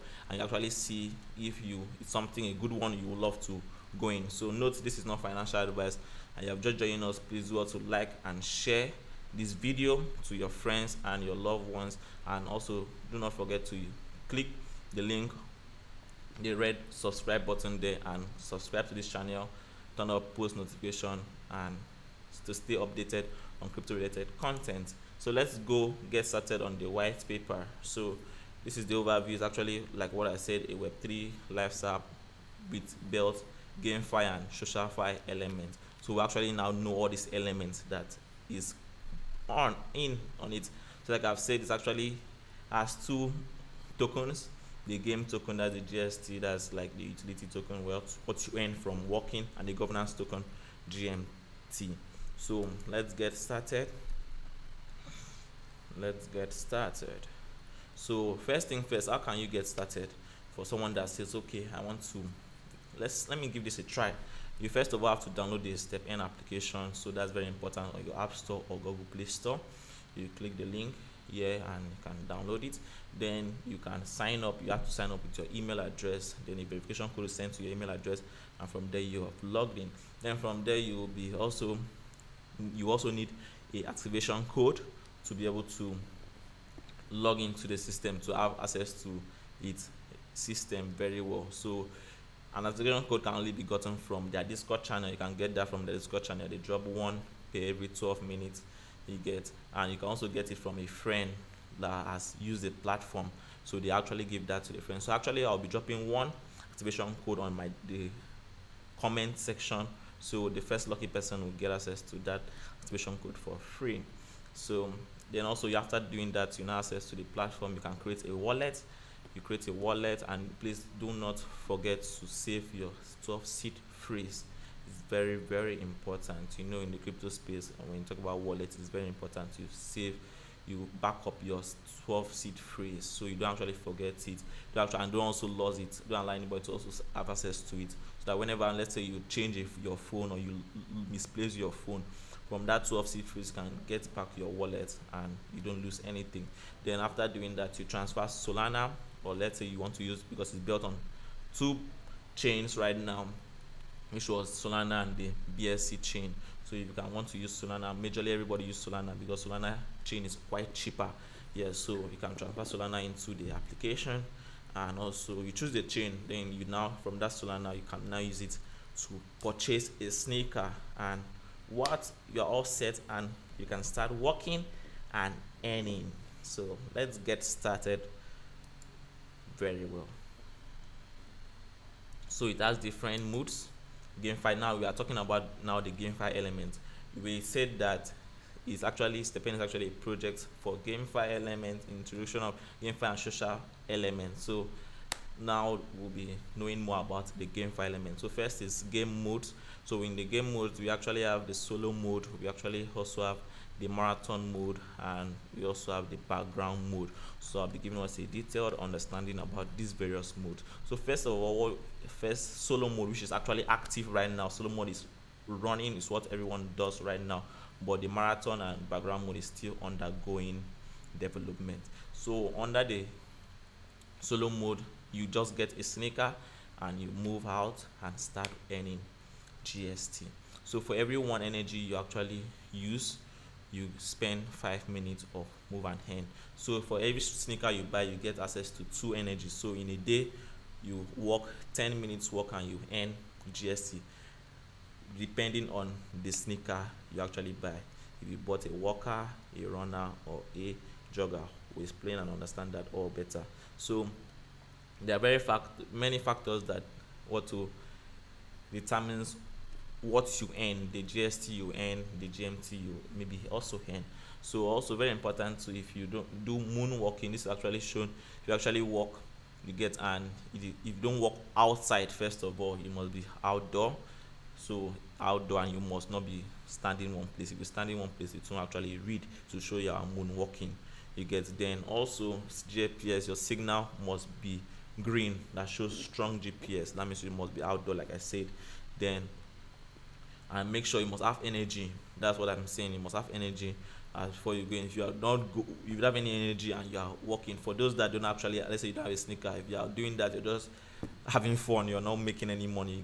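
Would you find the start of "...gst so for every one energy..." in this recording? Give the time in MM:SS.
03:49.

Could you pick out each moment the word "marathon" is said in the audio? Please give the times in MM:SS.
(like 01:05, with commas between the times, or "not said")
03:23, 03:38.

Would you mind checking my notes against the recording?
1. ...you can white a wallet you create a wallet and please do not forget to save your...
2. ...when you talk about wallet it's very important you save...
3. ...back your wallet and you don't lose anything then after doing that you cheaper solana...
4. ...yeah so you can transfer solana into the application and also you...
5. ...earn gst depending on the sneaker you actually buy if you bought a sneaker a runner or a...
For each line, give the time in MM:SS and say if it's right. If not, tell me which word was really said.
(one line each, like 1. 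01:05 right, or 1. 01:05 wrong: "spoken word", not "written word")
1. 01:57 wrong: "create", not "white"
2. 02:07 right
3. 02:24 wrong: "transfer", not "cheaper"
4. 02:41 right
5. 04:02 wrong: "walker", not "sneaker".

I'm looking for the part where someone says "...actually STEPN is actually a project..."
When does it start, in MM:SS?
03:08.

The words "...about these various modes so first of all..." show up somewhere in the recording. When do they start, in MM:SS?
03:29.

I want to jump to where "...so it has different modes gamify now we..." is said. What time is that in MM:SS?
03:02.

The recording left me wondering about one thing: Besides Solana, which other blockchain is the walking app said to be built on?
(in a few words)
BSC.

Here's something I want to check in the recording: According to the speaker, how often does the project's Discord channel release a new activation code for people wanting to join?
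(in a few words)
every 12 minutes.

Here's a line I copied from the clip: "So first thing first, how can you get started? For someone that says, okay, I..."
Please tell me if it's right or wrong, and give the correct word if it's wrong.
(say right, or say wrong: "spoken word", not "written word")
right.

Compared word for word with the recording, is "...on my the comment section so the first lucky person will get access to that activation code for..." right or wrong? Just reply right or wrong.
right.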